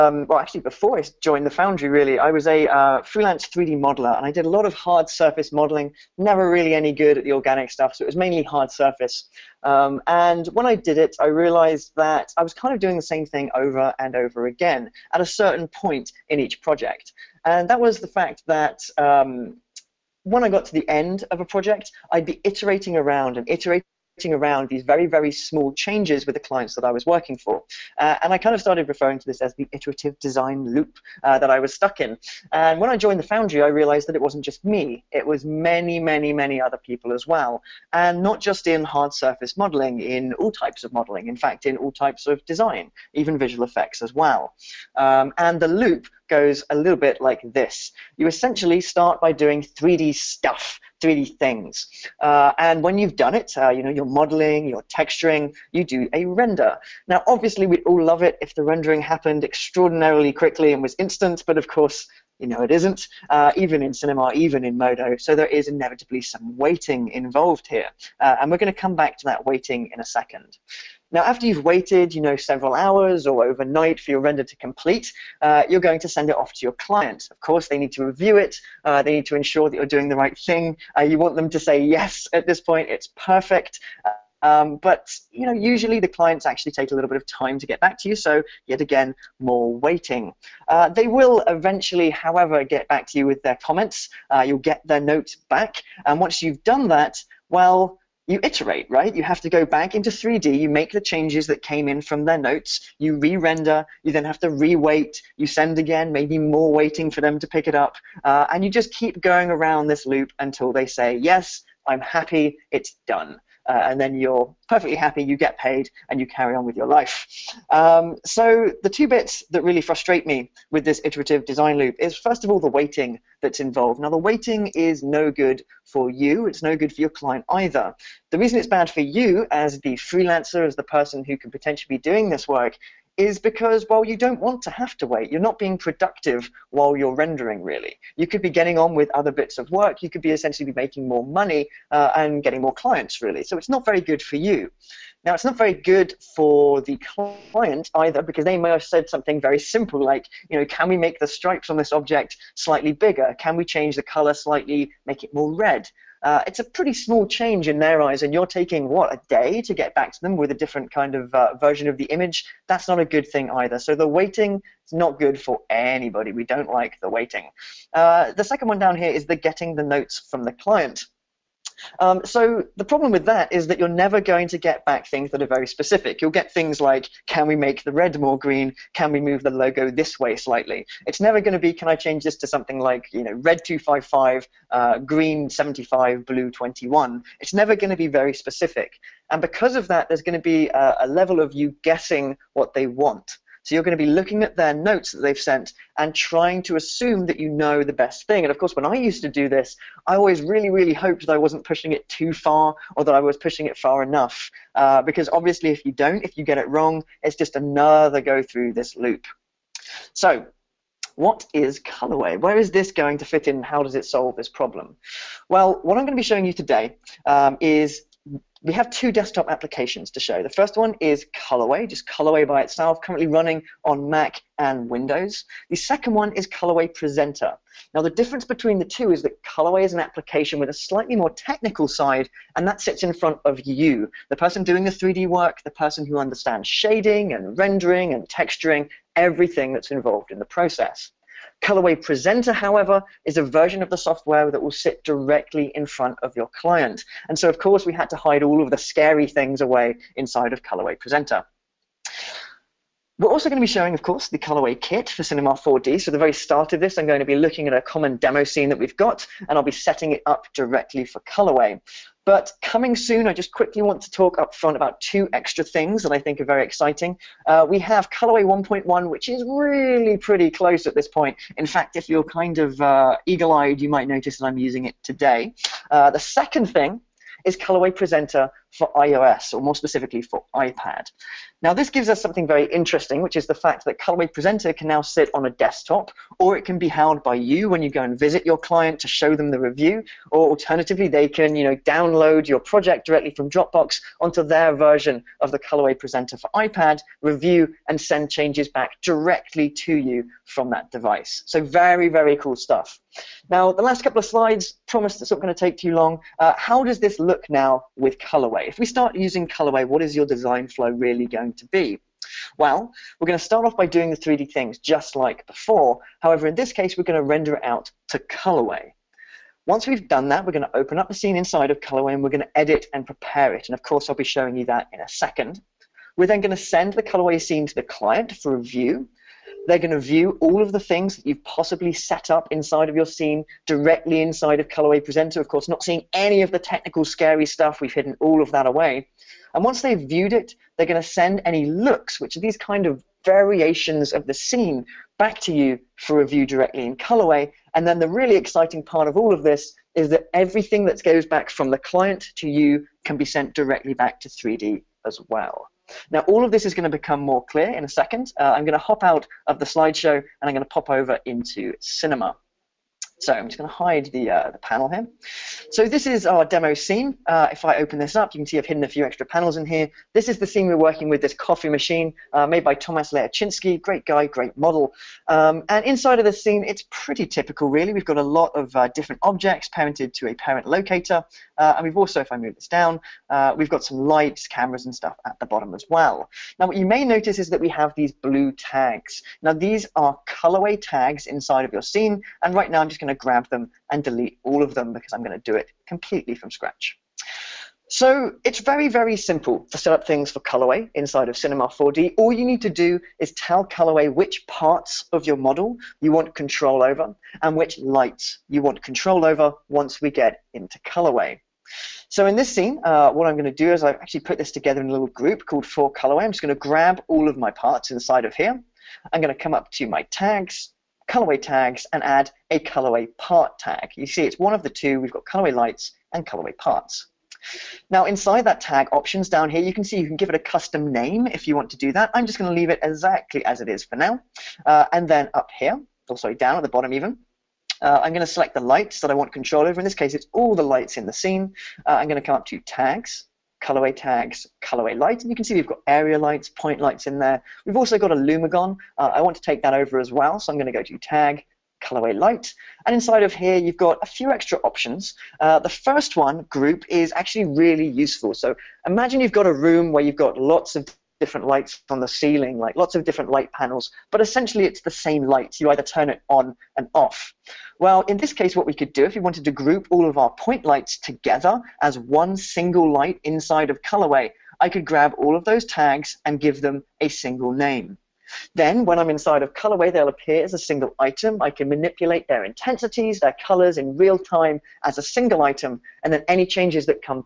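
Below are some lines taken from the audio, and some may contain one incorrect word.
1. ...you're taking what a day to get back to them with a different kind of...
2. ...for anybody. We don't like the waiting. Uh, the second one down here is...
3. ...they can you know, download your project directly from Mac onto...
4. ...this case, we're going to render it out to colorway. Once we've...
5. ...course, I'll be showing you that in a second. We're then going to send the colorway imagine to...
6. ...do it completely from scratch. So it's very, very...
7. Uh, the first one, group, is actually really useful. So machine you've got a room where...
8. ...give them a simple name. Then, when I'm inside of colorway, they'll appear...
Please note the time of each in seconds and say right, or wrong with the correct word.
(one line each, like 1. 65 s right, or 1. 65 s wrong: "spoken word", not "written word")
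1. 158 s right
2. 165 s right
3. 291 s wrong: "Dropbox", not "Mac"
4. 316 s right
5. 323 s wrong: "scene", not "imagine"
6. 395 s right
7. 455 s wrong: "imagine", not "machine"
8. 476 s wrong: "single", not "simple".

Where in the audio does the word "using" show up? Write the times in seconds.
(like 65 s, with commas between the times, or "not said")
274 s, 309 s.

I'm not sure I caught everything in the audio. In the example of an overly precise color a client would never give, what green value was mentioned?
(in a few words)
75.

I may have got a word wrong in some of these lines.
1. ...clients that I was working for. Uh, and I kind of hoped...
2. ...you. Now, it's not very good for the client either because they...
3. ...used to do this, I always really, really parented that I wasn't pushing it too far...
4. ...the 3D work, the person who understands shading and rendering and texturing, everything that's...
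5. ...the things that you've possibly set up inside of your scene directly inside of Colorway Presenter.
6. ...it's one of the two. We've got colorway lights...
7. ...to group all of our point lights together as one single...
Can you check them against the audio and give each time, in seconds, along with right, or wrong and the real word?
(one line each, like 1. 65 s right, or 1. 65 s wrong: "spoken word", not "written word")
1. 26 s wrong: "started", not "hoped"
2. 144 s right
3. 198 s wrong: "hoped", not "parented"
4. 234 s right
5. 330 s right
6. 424 s right
7. 469 s right.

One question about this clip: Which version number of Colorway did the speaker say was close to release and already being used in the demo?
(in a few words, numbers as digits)
1.1.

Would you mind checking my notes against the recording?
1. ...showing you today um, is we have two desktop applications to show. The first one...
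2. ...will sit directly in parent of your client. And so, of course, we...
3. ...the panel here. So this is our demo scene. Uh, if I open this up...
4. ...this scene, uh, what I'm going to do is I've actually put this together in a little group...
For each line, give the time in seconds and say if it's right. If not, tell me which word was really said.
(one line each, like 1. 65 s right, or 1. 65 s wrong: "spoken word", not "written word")
1. 216 s right
2. 244 s wrong: "front", not "parent"
3. 364 s right
4. 412 s right.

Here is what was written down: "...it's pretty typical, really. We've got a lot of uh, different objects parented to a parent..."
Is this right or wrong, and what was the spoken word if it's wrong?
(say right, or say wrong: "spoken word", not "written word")
right.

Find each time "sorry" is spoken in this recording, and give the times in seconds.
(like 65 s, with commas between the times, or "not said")
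436 s.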